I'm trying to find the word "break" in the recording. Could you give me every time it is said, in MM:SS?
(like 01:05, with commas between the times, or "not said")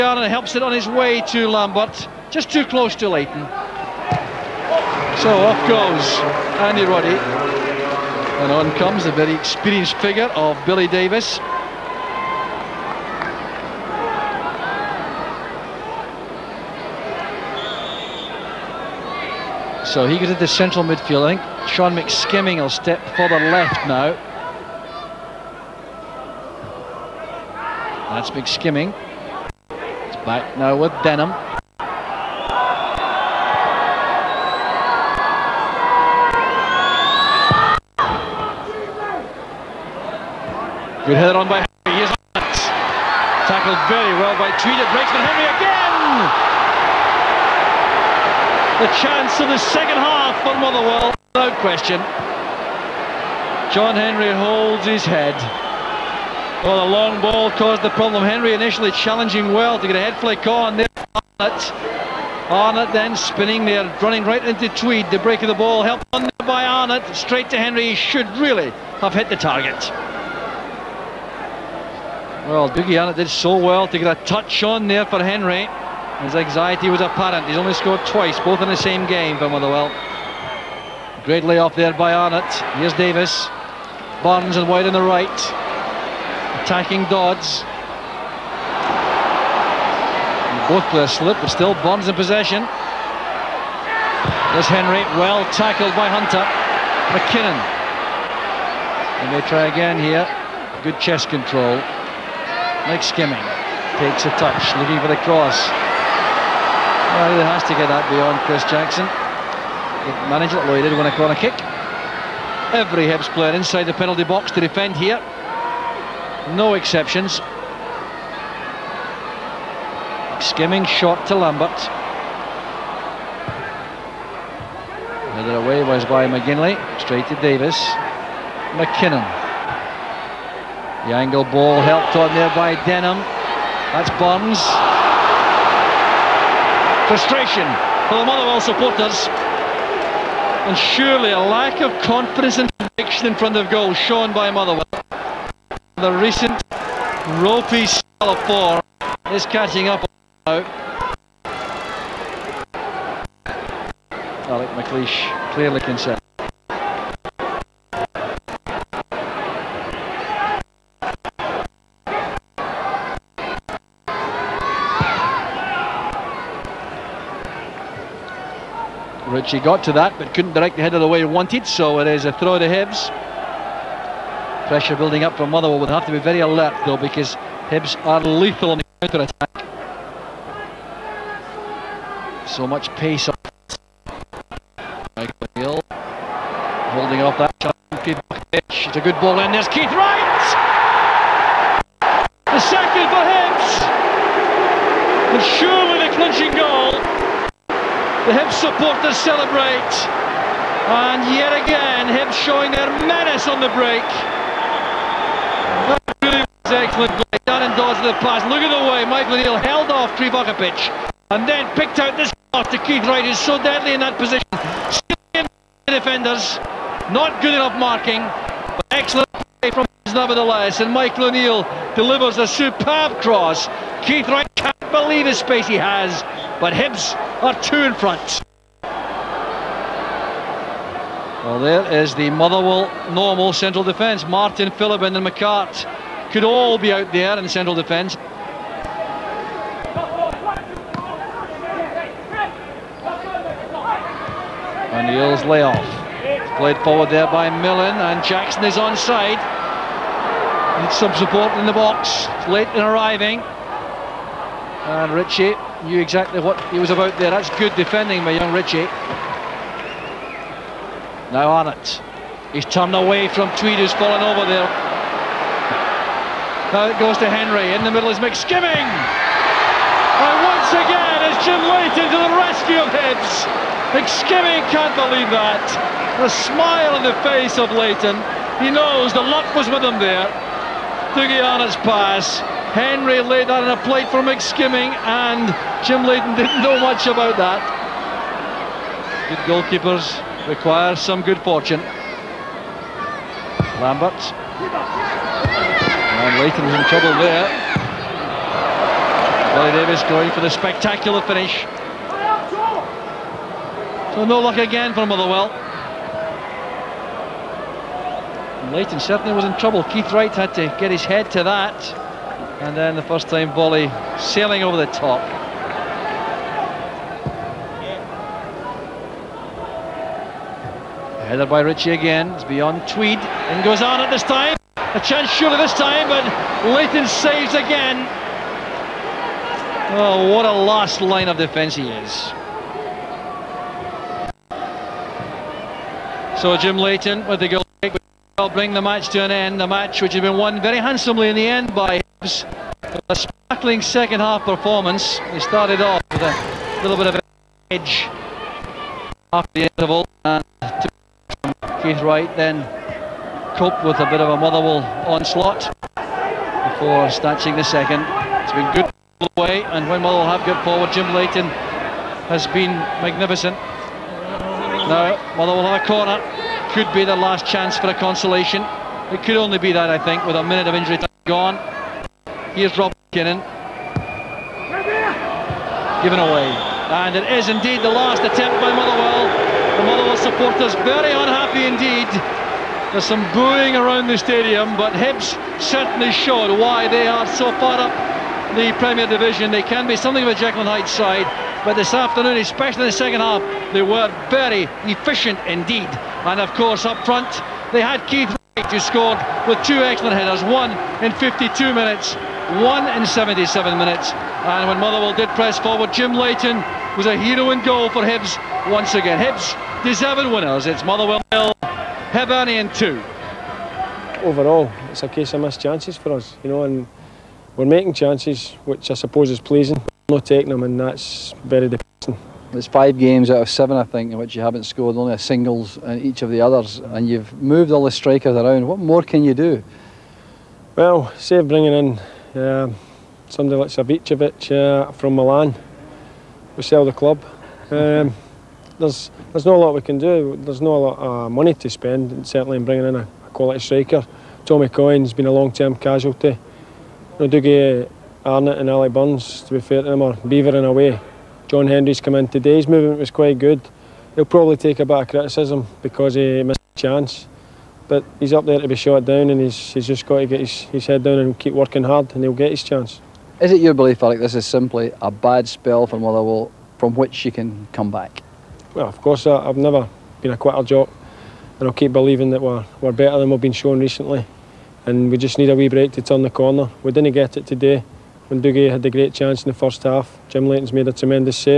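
00:44, 01:05, 03:23, 07:55.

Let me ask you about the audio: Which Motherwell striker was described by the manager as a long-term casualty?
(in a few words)
Tommy Coyne.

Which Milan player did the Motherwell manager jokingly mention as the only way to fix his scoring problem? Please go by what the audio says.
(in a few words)
Savicevic.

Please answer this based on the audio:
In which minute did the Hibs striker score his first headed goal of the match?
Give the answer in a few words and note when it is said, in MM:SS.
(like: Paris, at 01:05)
52, at 06:41.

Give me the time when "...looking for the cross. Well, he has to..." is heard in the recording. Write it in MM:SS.
01:44.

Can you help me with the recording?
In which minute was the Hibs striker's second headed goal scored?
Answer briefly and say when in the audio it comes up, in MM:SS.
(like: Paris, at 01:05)
77, at 06:43.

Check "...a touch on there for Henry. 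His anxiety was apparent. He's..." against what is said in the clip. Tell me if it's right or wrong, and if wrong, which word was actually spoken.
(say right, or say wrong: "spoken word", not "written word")
right.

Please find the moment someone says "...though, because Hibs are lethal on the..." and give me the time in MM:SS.
02:56.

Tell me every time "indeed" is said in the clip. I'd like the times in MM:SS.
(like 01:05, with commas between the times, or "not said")
06:17, 06:21, 06:35.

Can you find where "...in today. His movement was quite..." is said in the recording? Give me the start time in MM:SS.
07:32.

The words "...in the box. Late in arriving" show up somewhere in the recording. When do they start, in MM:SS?
04:11.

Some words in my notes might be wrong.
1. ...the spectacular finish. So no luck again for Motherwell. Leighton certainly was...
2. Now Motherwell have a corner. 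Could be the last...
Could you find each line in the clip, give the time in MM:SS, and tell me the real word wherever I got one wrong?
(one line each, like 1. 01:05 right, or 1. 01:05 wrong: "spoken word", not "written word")
1. 05:00 right
2. 06:04 right.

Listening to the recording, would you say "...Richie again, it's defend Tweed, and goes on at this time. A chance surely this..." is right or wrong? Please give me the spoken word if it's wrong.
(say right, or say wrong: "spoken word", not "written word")
wrong: "beyond", not "defend".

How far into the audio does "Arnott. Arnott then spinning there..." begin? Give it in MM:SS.
01:01.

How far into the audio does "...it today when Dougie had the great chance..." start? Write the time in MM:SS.
07:57.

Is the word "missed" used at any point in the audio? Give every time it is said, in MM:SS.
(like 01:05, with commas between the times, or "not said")
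06:55, 07:36.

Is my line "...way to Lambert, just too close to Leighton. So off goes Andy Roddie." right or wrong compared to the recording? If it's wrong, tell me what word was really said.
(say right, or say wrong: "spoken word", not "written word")
right.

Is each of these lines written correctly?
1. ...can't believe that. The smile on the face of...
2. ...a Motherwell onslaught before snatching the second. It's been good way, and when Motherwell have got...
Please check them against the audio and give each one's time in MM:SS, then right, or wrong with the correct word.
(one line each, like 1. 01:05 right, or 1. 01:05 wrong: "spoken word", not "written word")
1. 04:34 right
2. 05:54 right.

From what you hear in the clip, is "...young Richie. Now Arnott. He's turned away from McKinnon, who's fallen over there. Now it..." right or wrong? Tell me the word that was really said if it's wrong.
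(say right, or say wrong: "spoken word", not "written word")
wrong: "Tweed", not "McKinnon".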